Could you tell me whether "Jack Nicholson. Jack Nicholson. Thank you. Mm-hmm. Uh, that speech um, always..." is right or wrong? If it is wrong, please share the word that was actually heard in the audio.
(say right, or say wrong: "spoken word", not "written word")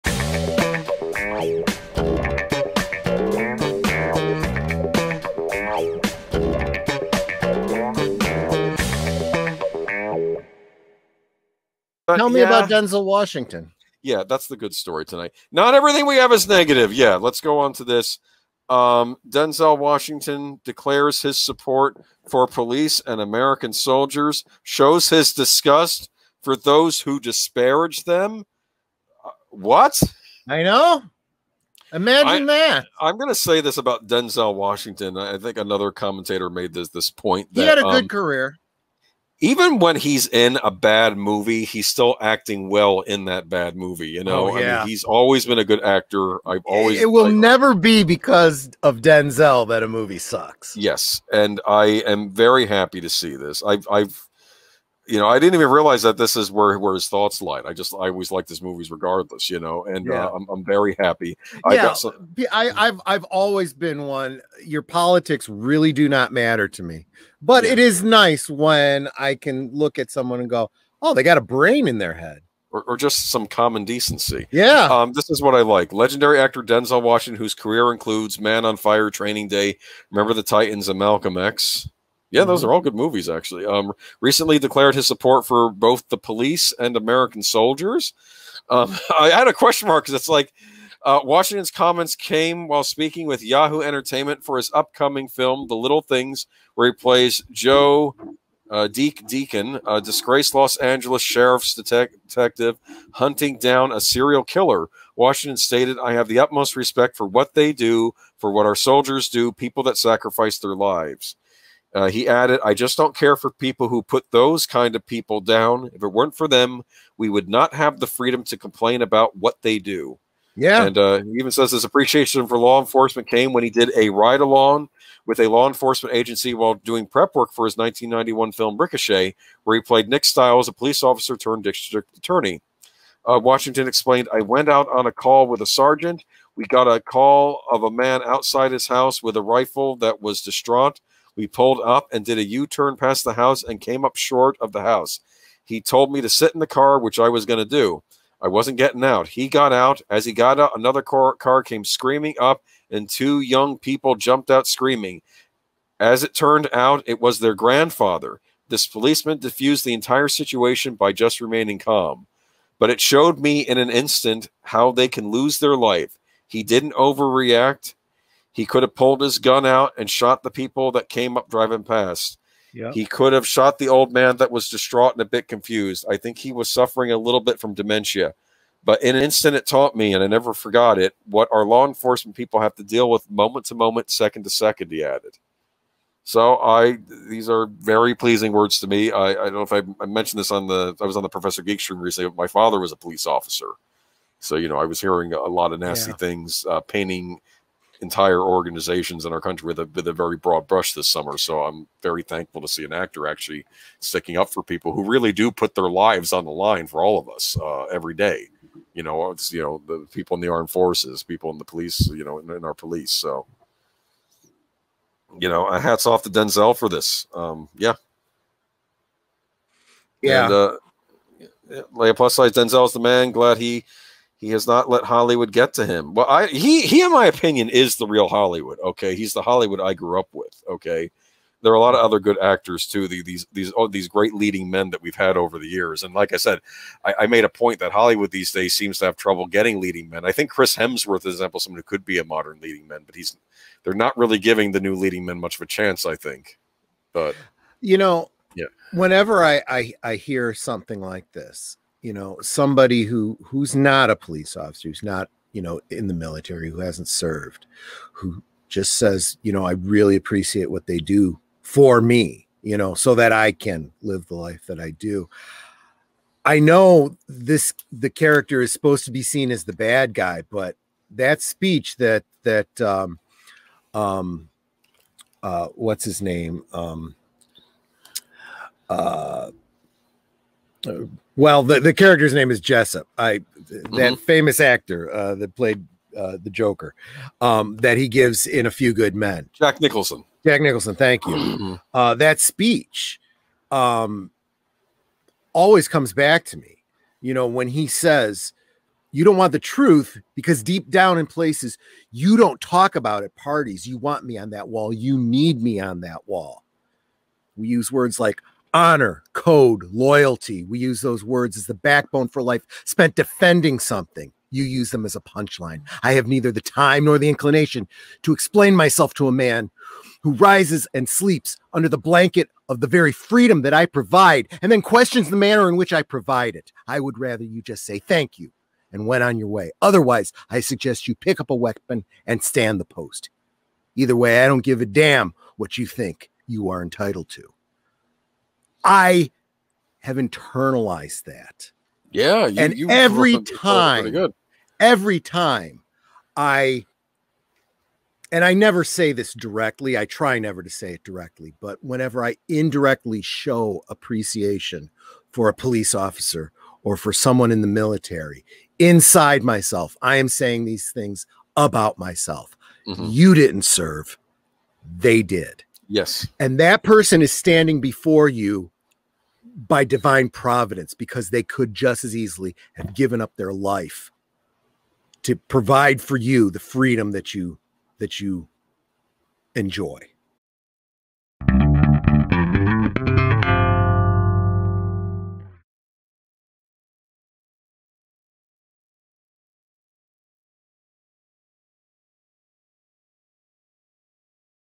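right.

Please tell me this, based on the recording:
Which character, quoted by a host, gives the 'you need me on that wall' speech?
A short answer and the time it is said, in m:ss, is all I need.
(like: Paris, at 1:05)
Jessep, at 4:42.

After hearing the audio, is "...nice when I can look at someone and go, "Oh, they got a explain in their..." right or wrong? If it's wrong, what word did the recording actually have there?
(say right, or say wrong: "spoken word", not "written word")
wrong: "brain", not "explain".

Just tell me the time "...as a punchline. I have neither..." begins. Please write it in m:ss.
5:15.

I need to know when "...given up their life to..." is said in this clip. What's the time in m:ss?
6:12.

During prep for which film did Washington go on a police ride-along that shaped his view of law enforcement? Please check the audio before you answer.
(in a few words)
Ricochet.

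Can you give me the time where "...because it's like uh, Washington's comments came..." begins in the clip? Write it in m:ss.
1:30.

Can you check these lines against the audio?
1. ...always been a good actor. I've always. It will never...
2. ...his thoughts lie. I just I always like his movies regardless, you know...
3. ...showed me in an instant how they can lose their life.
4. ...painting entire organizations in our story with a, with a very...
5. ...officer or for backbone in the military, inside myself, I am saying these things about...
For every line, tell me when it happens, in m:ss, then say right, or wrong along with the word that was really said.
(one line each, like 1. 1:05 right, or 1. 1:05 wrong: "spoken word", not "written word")
1. 0:45 right
2. 0:56 right
3. 2:42 right
4. 3:16 wrong: "country", not "story"
5. 5:55 wrong: "someone", not "backbone".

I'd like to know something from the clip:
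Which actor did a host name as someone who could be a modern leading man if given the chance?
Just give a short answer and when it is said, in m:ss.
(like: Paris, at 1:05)
Chris Hemsworth, at 4:00.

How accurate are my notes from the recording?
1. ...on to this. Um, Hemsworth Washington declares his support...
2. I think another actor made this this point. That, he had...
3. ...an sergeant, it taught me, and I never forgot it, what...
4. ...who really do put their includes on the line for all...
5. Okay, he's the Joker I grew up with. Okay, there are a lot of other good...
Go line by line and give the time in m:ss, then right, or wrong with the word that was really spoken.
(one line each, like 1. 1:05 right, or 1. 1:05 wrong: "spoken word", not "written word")
1. 0:17 wrong: "Denzel", not "Hemsworth"
2. 0:35 wrong: "commentator", not "actor"
3. 2:59 wrong: "instant", not "sergeant"
4. 3:24 wrong: "lives", not "includes"
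5. 3:48 wrong: "Hollywood", not "Joker".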